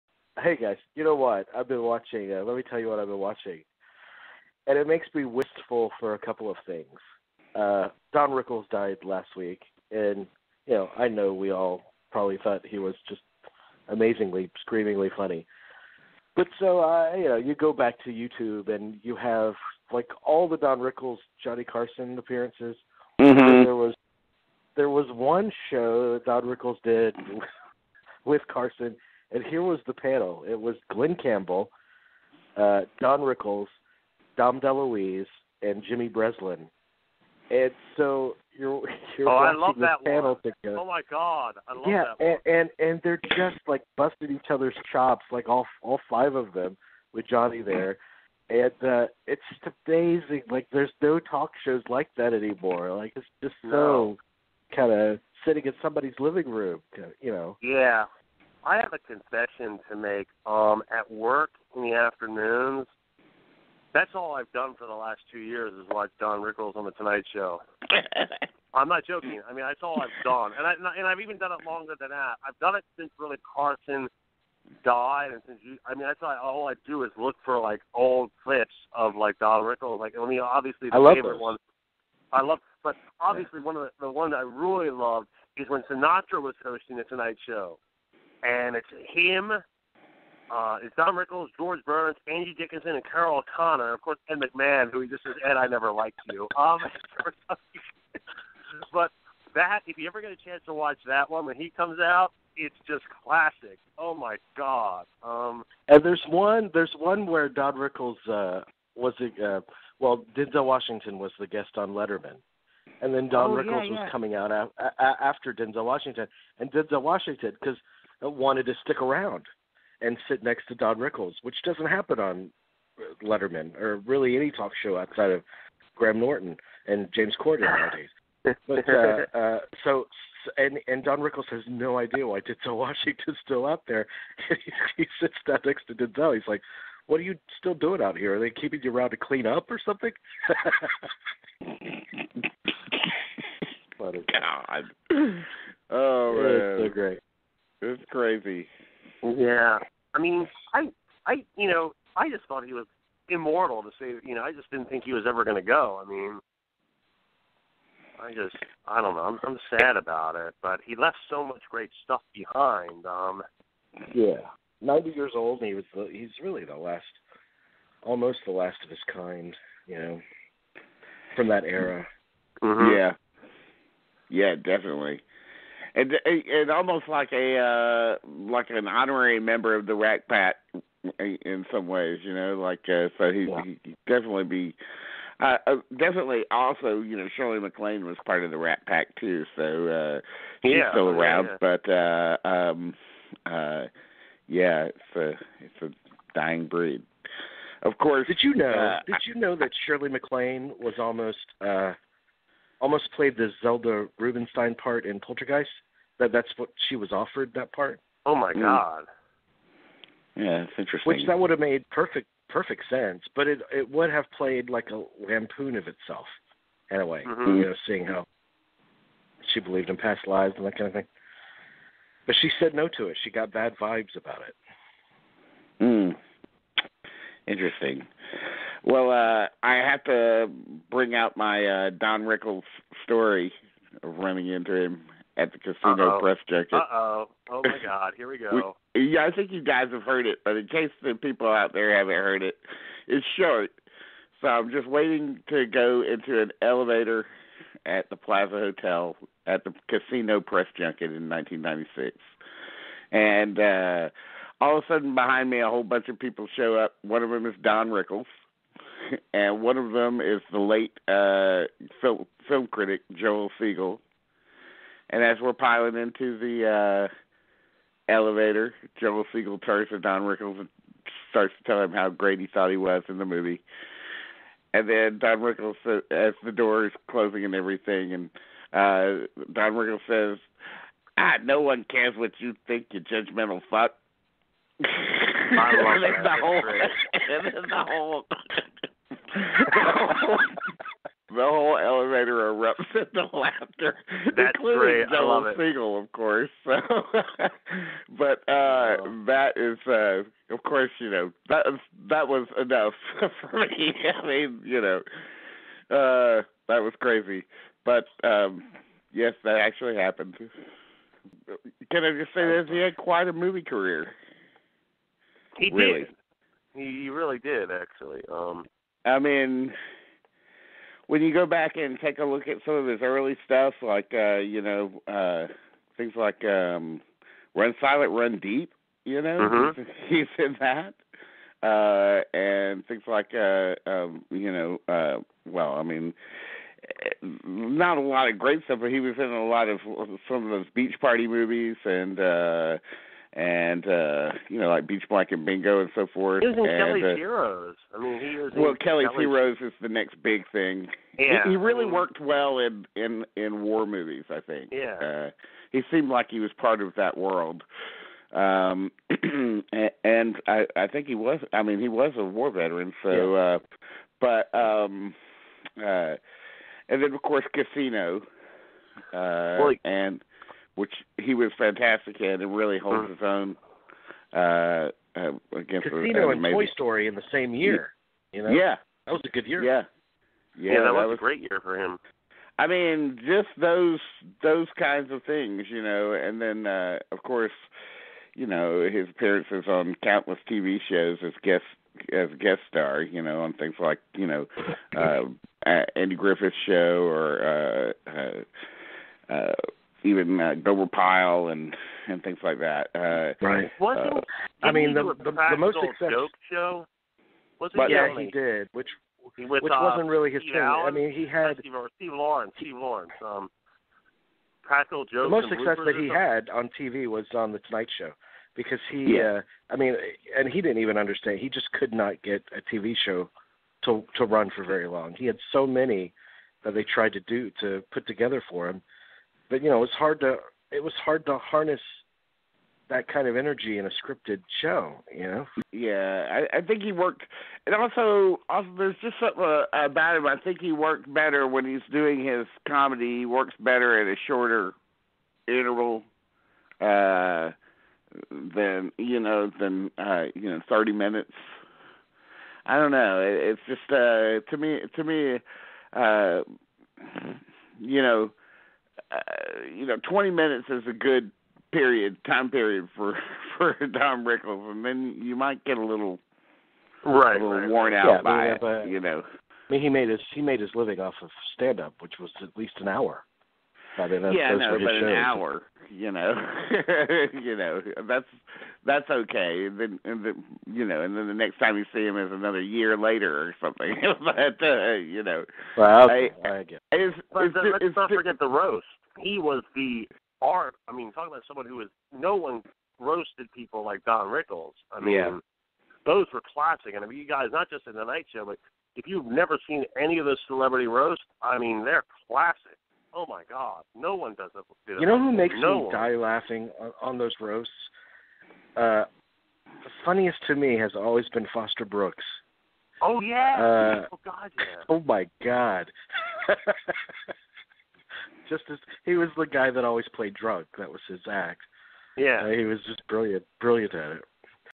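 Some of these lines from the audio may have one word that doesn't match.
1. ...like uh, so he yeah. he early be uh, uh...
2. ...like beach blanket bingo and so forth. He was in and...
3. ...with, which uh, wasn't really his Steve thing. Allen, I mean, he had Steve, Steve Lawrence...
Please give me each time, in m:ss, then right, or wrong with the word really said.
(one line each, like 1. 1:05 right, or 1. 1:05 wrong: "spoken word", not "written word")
1. 3:02 wrong: "definitely", not "early"
2. 5:44 right
3. 6:49 right.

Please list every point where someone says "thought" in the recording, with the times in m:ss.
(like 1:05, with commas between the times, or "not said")
0:12, 2:32, 4:32.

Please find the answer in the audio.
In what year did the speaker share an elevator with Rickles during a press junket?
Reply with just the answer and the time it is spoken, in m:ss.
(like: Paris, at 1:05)
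1996, at 4:11.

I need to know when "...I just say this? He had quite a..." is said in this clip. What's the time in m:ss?
5:12.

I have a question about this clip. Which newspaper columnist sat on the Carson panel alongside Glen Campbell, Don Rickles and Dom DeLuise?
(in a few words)
Jimmy Breslin.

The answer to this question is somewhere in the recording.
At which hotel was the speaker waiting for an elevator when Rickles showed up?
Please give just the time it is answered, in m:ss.
4:08.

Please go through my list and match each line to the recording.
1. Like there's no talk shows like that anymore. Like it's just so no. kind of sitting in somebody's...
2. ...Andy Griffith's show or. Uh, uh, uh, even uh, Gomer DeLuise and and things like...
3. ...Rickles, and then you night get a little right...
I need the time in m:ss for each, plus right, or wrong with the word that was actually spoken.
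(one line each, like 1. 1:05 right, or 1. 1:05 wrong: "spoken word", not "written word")
1. 0:50 right
2. 6:35 wrong: "Pyle", not "DeLuise"
3. 7:44 wrong: "might", not "night".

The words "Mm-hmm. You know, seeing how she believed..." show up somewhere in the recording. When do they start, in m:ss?
3:37.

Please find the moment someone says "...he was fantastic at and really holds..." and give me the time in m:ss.
6:11.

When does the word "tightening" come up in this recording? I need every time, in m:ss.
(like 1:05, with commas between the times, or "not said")
not said.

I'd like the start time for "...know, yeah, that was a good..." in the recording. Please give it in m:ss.
6:18.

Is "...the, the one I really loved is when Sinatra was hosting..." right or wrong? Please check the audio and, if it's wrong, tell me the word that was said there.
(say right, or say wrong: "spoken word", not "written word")
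right.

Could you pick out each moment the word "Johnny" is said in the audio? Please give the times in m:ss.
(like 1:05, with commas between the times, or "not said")
0:21, 0:47.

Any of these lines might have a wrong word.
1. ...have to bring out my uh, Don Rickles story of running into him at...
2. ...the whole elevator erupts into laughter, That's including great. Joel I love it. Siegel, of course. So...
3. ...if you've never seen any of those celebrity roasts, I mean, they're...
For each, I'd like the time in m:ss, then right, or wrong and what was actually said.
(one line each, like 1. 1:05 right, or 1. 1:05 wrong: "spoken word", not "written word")
1. 3:49 right
2. 4:51 right
3. 8:18 right.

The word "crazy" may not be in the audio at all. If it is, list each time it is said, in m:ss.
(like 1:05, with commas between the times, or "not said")
2:28, 5:06.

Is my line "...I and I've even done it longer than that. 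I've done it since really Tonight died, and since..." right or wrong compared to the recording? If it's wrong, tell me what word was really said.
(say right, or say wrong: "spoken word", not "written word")
wrong: "Carson", not "Tonight".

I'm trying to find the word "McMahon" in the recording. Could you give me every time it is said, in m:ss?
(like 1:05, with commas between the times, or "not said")
1:34.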